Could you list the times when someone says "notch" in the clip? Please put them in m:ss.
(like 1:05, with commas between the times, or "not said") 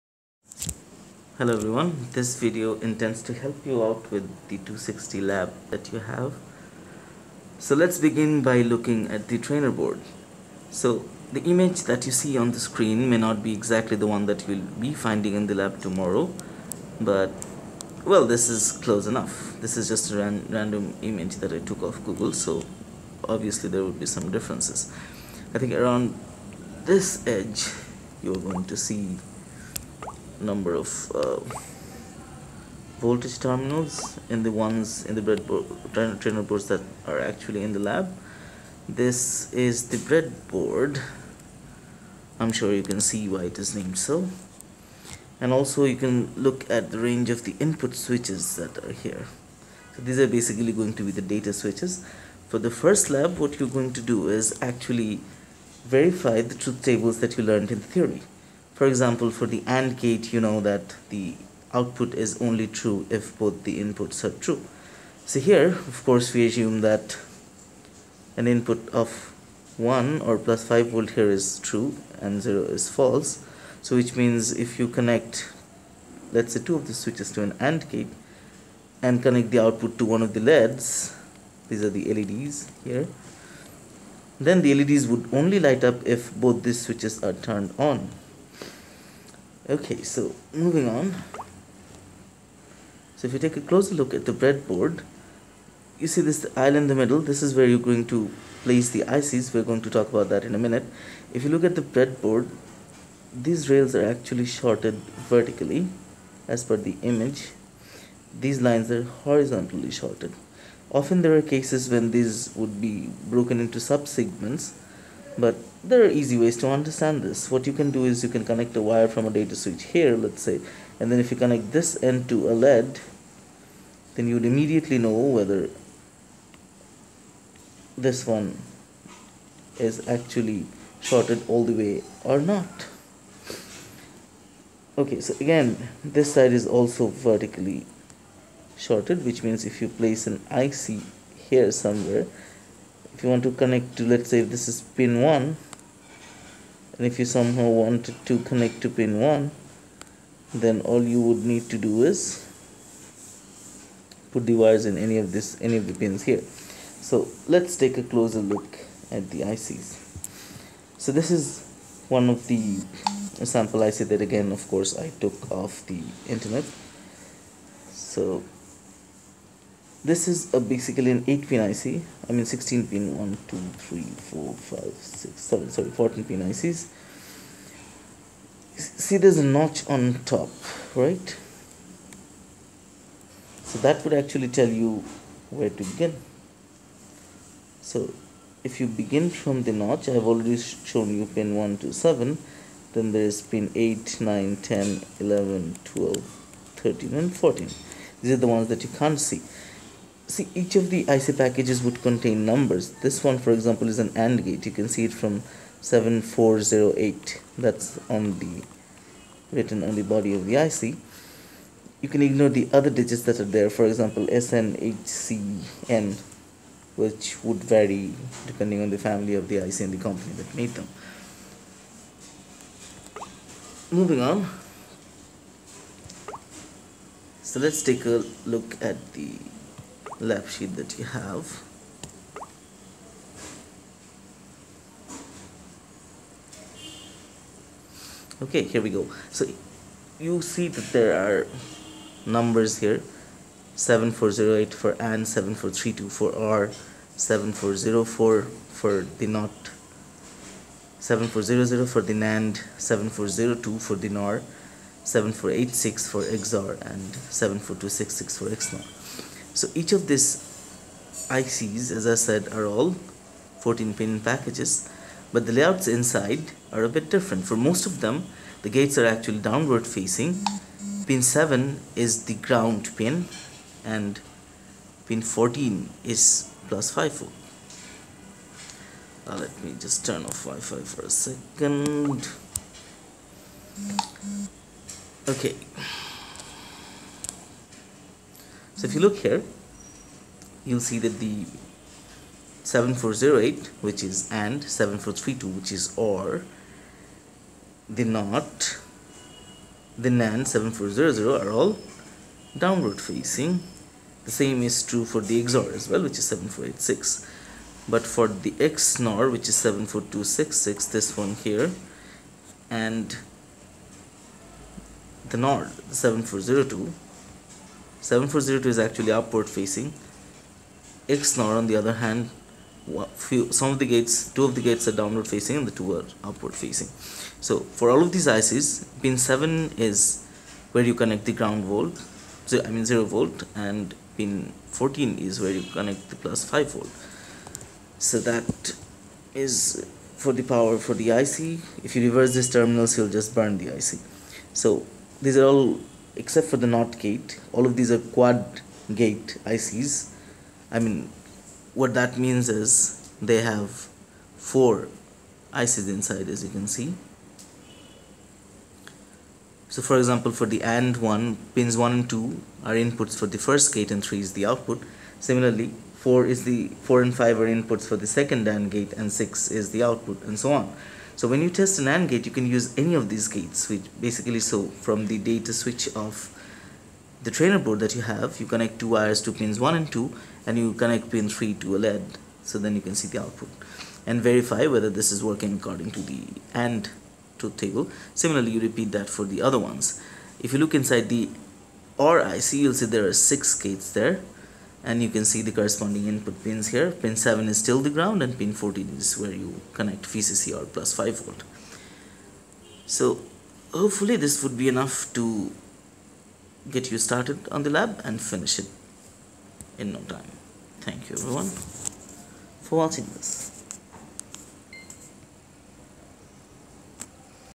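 2:59, 3:09.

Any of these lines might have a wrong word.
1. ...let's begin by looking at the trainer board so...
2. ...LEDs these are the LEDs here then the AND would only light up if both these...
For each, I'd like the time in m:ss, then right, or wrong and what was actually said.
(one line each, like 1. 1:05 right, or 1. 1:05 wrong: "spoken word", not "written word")
1. 0:07 right
2. 1:20 wrong: "LEDs", not "AND".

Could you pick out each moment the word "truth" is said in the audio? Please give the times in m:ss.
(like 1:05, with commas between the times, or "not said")
0:56, 6:27.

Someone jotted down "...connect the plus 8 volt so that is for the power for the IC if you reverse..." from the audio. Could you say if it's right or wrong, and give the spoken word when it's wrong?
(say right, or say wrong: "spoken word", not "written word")
wrong: "5", not "8".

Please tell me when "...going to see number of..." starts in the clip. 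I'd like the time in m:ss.
0:28.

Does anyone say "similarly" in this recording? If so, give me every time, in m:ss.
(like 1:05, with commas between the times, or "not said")
6:05, 6:28.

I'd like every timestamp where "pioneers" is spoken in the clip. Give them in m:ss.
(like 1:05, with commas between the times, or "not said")
not said.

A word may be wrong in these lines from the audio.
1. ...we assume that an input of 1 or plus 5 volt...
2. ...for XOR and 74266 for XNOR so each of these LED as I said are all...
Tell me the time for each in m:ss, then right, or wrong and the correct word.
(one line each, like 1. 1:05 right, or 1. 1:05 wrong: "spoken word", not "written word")
1. 1:06 right
2. 4:16 wrong: "ICs", not "LED".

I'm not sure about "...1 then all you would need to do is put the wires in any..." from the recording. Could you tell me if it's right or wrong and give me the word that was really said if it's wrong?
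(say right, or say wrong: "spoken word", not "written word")
right.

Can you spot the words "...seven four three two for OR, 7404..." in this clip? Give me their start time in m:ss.
4:05.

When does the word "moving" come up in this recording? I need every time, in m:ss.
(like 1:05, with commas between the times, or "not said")
1:30, 3:43.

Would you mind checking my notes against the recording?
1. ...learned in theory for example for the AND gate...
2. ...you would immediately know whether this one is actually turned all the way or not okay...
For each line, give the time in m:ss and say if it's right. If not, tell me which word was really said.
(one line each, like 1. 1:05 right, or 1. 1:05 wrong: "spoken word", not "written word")
1. 0:57 right
2. 2:04 wrong: "shorted", not "turned".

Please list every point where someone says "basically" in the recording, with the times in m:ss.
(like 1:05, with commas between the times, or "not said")
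0:50, 2:50, 6:13.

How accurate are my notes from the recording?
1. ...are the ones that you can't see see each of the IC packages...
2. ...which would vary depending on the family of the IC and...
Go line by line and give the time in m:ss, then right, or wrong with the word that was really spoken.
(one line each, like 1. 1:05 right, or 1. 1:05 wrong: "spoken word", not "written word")
1. 3:18 right
2. 3:36 right.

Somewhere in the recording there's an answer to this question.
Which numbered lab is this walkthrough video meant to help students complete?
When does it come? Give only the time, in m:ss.
0:04.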